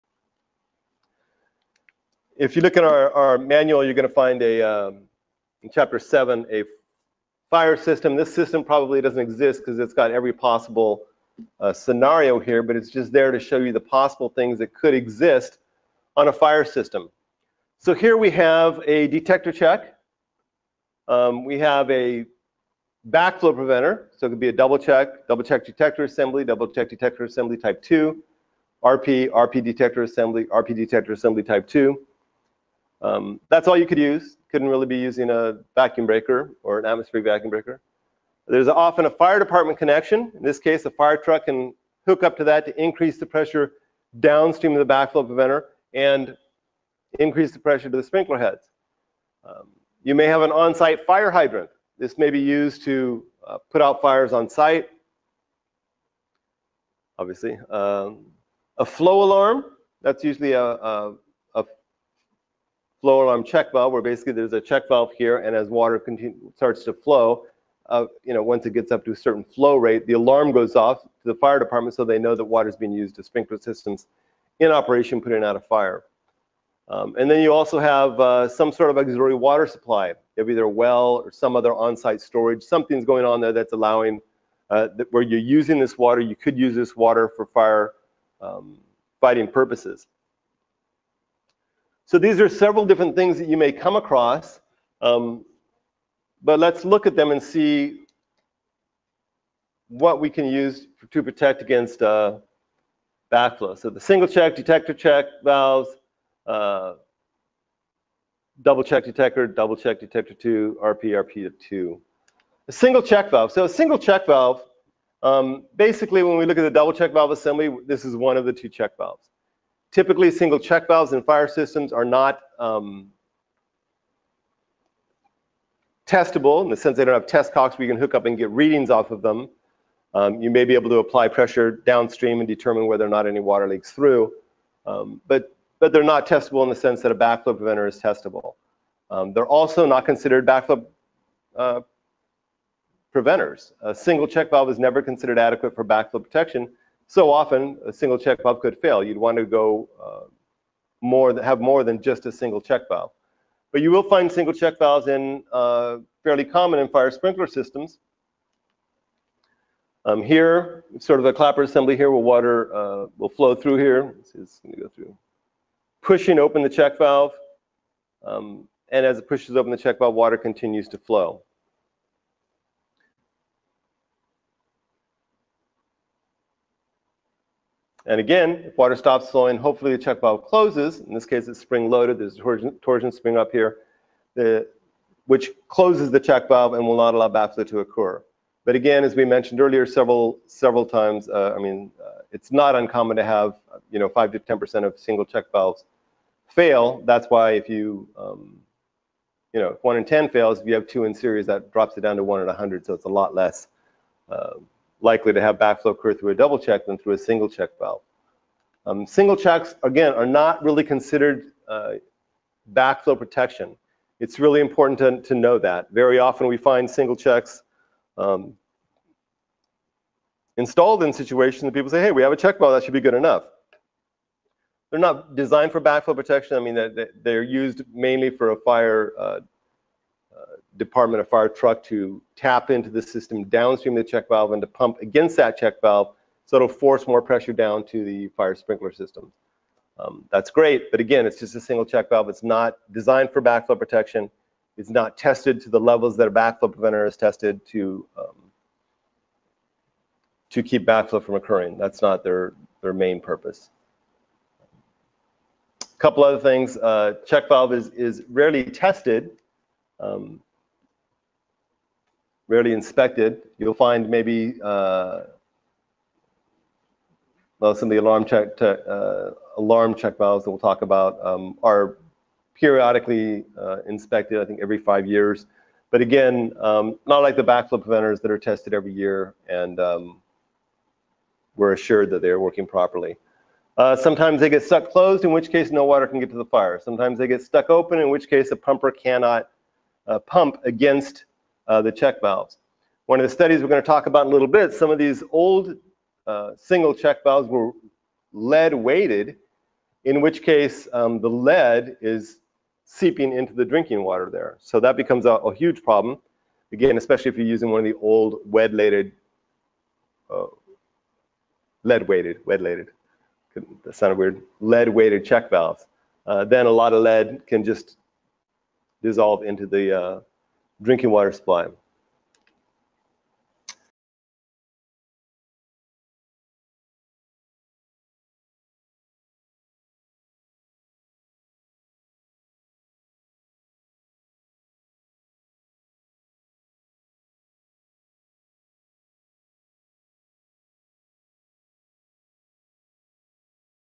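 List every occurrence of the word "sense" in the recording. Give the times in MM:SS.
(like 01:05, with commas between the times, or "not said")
02:06, 02:16.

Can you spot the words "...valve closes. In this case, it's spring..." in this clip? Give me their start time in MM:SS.
03:00.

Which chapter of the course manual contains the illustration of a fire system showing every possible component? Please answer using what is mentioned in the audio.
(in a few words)
Chapter 7.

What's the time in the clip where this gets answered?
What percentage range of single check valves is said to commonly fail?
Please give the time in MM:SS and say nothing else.
03:14.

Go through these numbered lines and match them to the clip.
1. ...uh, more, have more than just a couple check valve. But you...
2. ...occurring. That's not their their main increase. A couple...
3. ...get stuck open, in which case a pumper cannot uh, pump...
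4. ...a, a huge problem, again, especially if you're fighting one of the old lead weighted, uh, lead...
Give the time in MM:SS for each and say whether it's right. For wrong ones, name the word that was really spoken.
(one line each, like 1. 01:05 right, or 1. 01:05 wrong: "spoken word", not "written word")
1. 02:30 wrong: "single", not "couple"
2. 04:11 wrong: "purpose", not "increase"
3. 04:47 right
4. 05:05 wrong: "using", not "fighting".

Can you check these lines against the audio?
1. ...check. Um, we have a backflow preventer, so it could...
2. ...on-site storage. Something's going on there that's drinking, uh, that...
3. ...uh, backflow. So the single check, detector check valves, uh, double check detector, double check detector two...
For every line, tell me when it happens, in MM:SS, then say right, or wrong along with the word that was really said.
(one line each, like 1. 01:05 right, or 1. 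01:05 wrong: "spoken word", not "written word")
1. 00:19 right
2. 01:21 wrong: "allowing", not "drinking"
3. 01:42 right.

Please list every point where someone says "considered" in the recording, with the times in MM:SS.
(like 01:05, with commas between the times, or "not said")
02:20, 02:25, 03:30.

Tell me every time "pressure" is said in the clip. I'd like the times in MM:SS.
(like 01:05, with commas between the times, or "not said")
00:43, 00:47, 02:11, 03:57.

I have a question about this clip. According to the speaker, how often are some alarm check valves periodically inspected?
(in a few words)
Every 5 years.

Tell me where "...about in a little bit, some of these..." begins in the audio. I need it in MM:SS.
04:54.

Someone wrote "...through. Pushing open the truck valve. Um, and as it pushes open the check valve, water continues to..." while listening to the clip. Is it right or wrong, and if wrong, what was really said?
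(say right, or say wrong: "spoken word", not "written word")
wrong: "check", not "truck".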